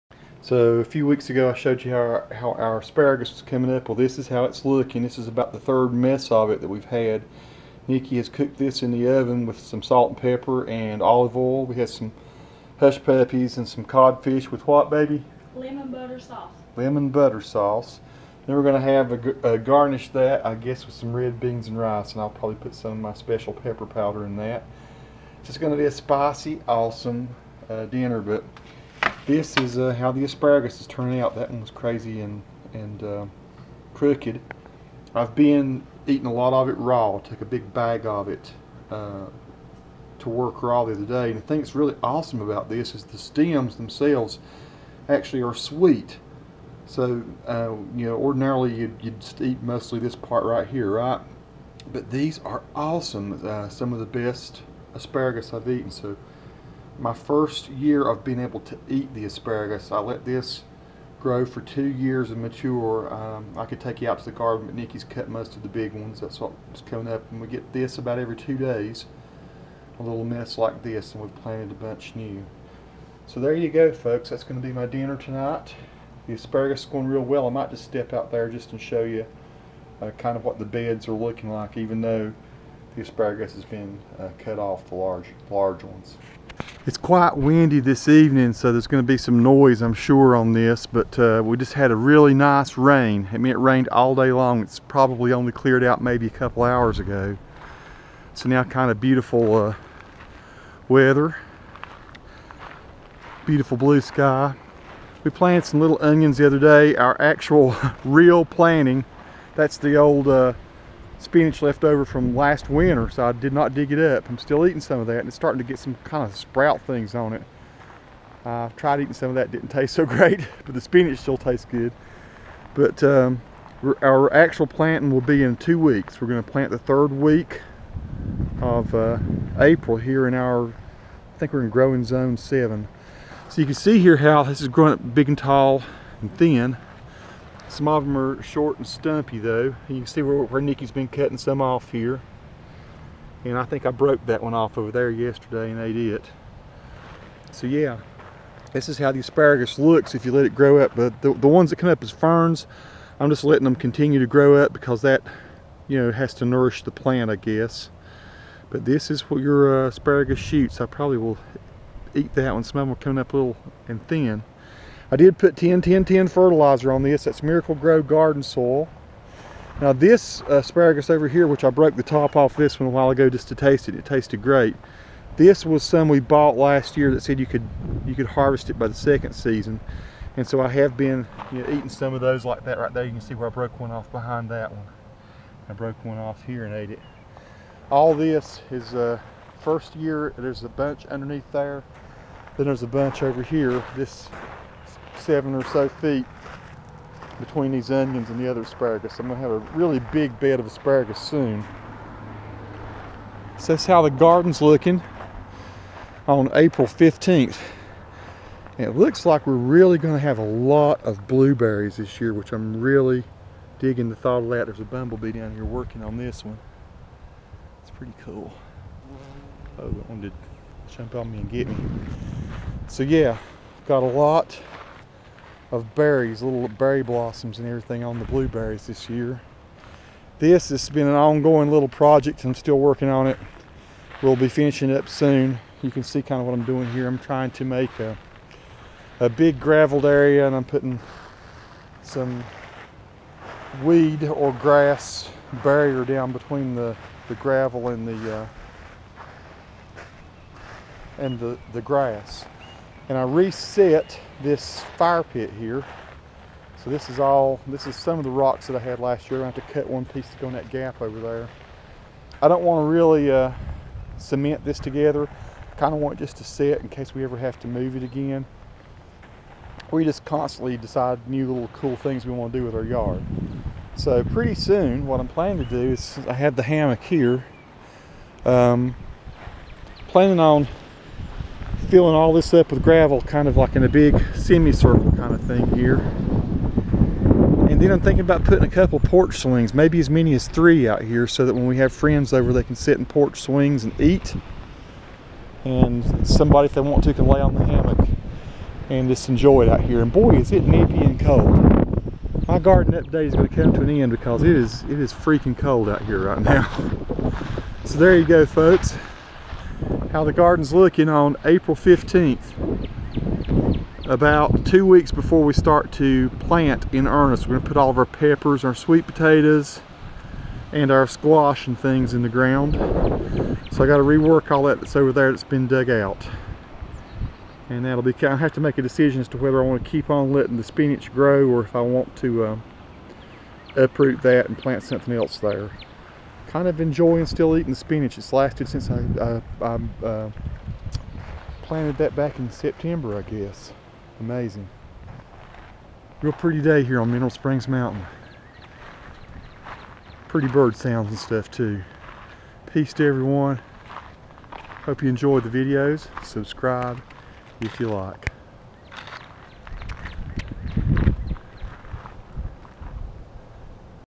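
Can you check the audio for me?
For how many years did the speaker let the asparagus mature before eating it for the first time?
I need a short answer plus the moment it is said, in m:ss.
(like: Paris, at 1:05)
2 years, at 1:01.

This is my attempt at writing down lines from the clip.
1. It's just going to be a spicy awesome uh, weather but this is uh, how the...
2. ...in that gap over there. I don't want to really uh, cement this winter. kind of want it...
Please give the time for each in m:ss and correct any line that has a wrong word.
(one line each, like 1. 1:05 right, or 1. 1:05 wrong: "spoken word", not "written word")
1. 0:25 wrong: "dinner", not "weather"
2. 4:20 wrong: "together", not "winter".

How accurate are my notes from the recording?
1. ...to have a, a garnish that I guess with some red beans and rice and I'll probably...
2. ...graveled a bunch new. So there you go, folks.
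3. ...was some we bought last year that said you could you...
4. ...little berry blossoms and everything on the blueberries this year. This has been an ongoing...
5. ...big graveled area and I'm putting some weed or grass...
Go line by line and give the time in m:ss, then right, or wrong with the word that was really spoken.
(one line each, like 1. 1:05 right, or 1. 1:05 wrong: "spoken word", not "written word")
1. 0:18 right
2. 1:11 wrong: "planted", not "graveled"
3. 2:55 right
4. 3:46 right
5. 3:59 right.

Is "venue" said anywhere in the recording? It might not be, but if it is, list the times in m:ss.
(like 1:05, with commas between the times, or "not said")
not said.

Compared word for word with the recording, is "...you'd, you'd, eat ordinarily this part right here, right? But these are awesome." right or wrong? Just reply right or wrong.
wrong.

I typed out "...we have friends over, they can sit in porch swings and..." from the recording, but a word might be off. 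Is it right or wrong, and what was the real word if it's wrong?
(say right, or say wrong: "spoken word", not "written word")
right.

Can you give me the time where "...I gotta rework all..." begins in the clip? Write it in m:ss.
5:23.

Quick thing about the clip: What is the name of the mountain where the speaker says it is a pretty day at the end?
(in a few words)
Mineral Springs Mountain.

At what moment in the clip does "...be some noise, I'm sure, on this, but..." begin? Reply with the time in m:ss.
1:29.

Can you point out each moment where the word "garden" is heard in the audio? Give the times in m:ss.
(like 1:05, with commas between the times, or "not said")
1:04, 2:48, 3:24, 5:02, 5:10.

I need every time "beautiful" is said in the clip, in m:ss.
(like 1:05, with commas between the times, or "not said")
1:38, 1:43.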